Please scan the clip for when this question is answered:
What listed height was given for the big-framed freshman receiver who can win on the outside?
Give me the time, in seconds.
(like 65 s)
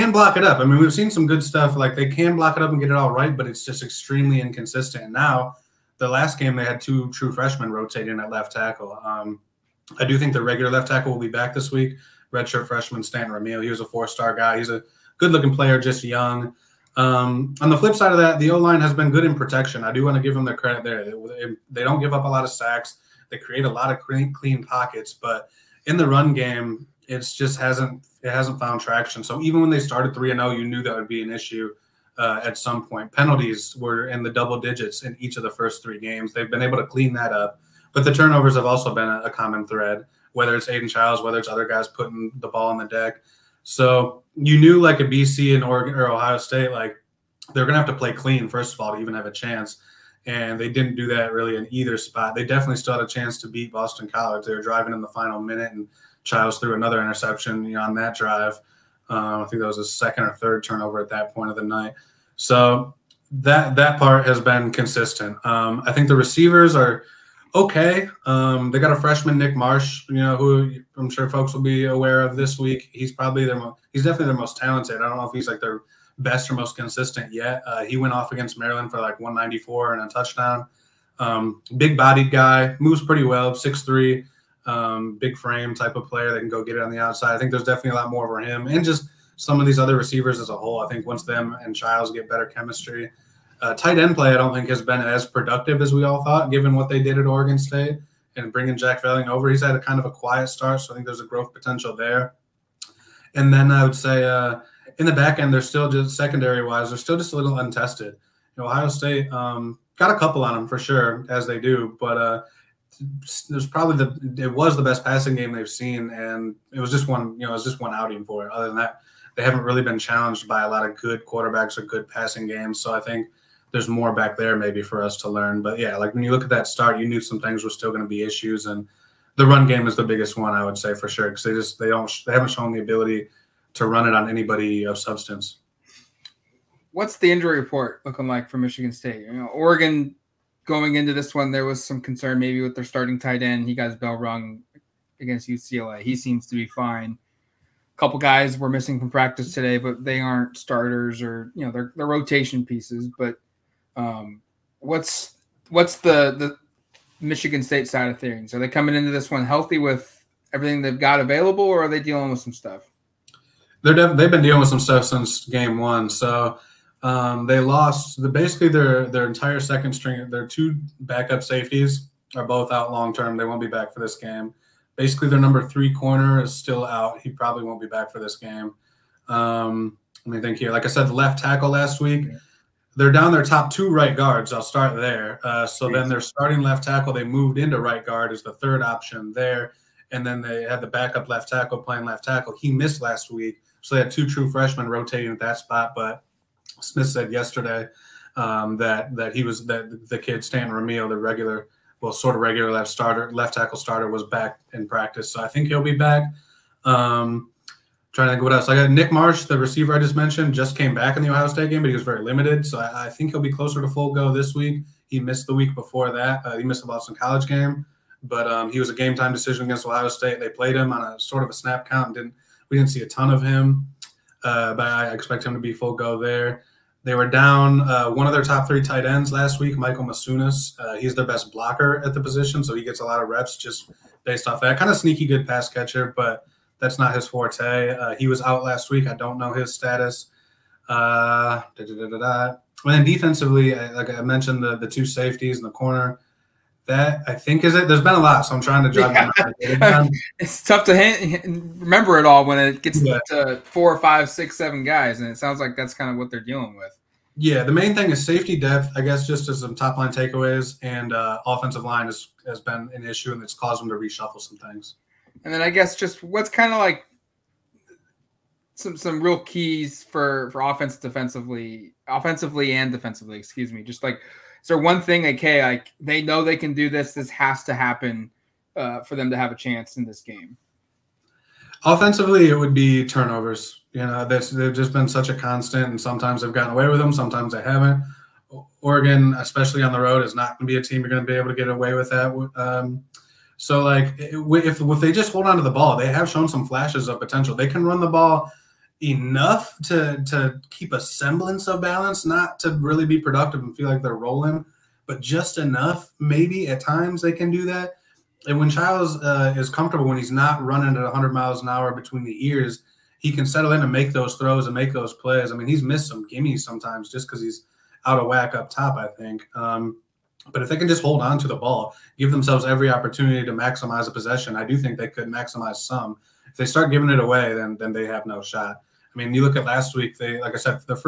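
83 s.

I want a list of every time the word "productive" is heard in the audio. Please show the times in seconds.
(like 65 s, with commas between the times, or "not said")
95 s, 303 s.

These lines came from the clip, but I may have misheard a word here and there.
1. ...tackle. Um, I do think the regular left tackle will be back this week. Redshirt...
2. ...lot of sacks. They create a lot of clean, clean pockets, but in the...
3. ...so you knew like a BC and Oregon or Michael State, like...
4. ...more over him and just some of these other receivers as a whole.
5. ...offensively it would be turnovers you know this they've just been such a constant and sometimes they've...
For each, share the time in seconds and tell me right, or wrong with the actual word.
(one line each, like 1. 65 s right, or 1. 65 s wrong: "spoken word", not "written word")
1. 8 s right
2. 22 s right
3. 43 s wrong: "Ohio", not "Michael"
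4. 88 s right
5. 281 s right.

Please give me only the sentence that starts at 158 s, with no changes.
Are they coming into this one healthy with everything they've got available, or are they dealing with some stuff?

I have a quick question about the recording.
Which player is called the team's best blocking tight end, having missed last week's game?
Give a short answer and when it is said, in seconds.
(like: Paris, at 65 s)
Michael Masunas, at 229 s.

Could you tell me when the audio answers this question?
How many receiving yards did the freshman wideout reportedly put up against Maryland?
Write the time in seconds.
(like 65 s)
79 s.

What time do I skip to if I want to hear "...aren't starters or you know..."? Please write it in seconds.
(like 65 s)
150 s.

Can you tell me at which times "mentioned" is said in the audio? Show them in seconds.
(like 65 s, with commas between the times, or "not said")
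210 s, 244 s.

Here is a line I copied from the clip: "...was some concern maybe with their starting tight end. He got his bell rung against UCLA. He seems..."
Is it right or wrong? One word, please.
right.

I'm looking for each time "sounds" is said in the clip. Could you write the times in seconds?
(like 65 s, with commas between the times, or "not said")
255 s.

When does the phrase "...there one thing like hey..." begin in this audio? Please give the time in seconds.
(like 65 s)
274 s.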